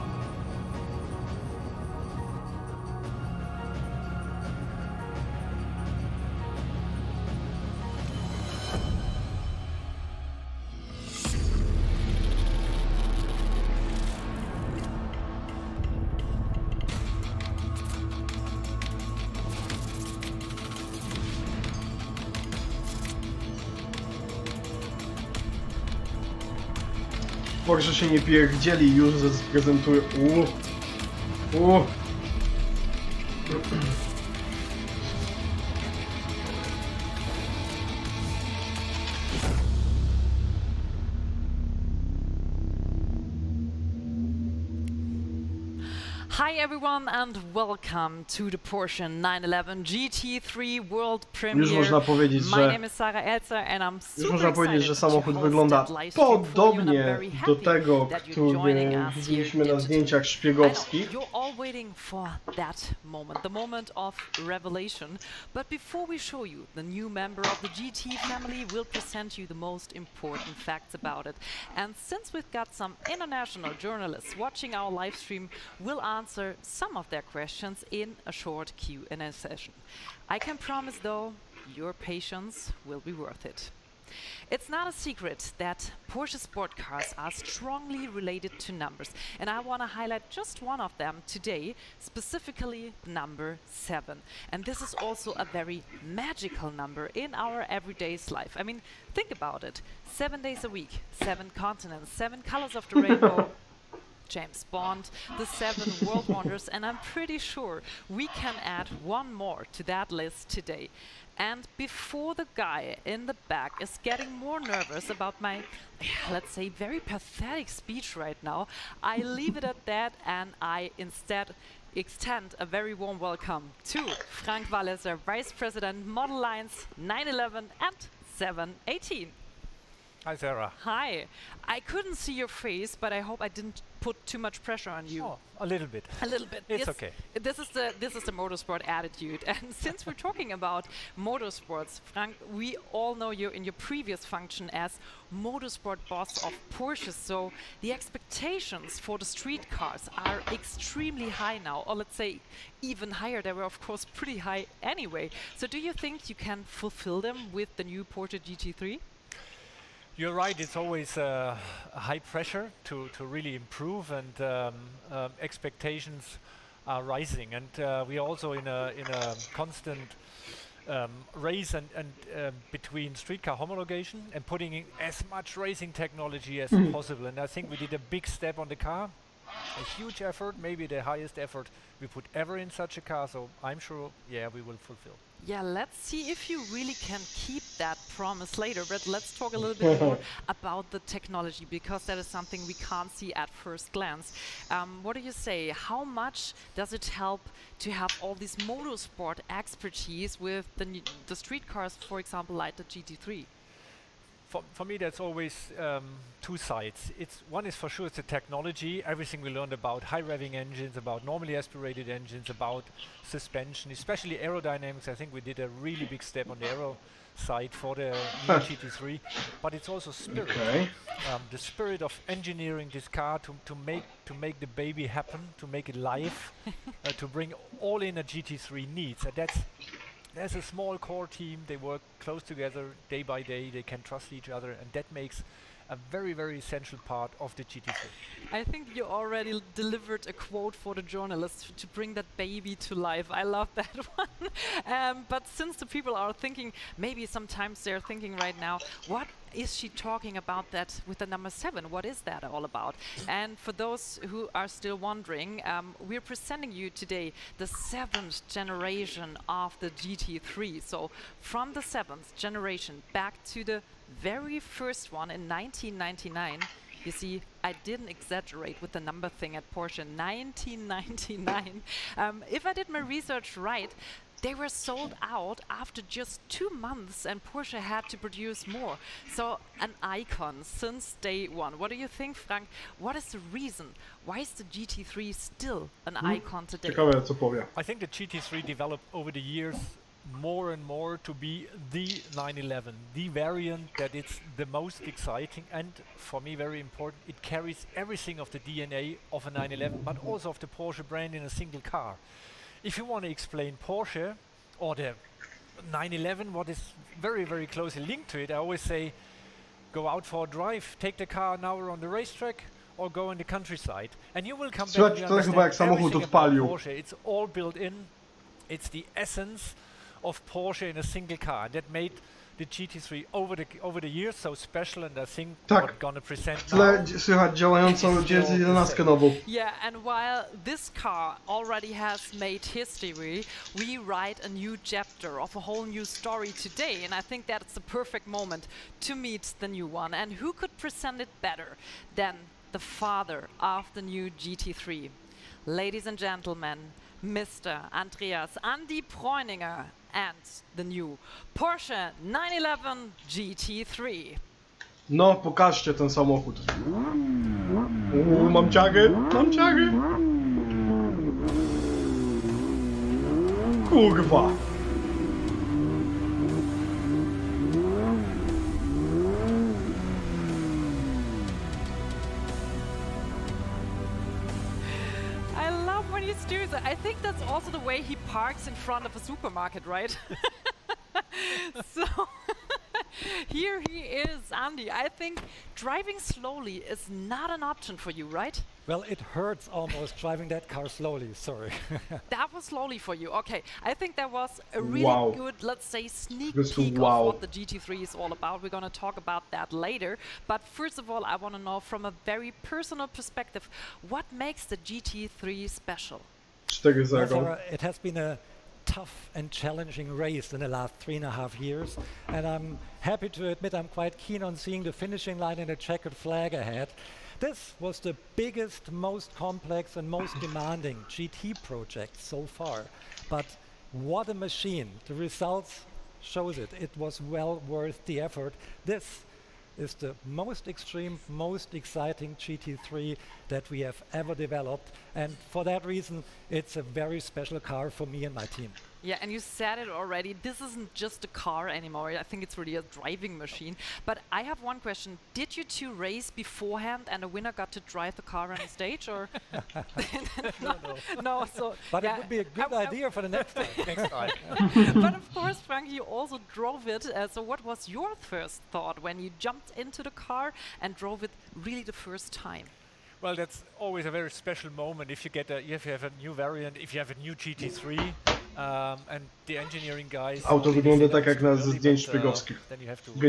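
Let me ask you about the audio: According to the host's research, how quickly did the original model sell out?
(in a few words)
Two months.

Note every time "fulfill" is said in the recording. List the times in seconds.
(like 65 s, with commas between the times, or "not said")
156 s, 184 s.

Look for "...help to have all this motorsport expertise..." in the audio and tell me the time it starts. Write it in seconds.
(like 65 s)
197 s.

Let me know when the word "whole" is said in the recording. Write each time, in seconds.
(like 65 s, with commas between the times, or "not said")
335 s.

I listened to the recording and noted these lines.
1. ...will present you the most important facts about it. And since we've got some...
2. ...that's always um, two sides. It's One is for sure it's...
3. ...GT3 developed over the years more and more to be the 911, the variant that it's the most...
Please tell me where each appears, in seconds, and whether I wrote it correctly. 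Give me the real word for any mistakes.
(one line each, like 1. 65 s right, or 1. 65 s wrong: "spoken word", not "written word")
1. 68 s right
2. 204 s right
3. 288 s right.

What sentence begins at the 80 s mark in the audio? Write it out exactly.
I can promise though, your patience will be worth it.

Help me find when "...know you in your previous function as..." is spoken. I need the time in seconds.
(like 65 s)
143 s.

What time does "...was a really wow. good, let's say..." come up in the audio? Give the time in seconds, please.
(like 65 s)
394 s.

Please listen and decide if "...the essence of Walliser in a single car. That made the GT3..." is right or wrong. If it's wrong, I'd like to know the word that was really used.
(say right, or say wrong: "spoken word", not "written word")
wrong: "Porsche", not "Walliser".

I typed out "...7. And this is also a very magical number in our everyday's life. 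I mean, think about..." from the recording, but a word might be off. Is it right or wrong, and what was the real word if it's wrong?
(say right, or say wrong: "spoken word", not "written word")
right.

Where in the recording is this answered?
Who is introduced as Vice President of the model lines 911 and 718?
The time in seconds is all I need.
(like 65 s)
124 s.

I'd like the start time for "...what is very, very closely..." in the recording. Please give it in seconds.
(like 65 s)
306 s.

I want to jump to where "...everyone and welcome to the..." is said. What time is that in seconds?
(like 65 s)
46 s.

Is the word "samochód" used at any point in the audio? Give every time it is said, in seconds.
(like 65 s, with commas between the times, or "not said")
54 s, 356 s.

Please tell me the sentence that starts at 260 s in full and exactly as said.
So from the seventh generation back to the very first one in 1999.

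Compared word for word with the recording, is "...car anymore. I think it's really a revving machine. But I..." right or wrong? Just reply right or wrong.
wrong.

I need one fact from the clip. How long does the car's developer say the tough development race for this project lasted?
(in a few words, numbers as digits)
Three and a half years.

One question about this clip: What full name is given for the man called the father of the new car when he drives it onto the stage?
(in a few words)
Andreas Andy Preuninger.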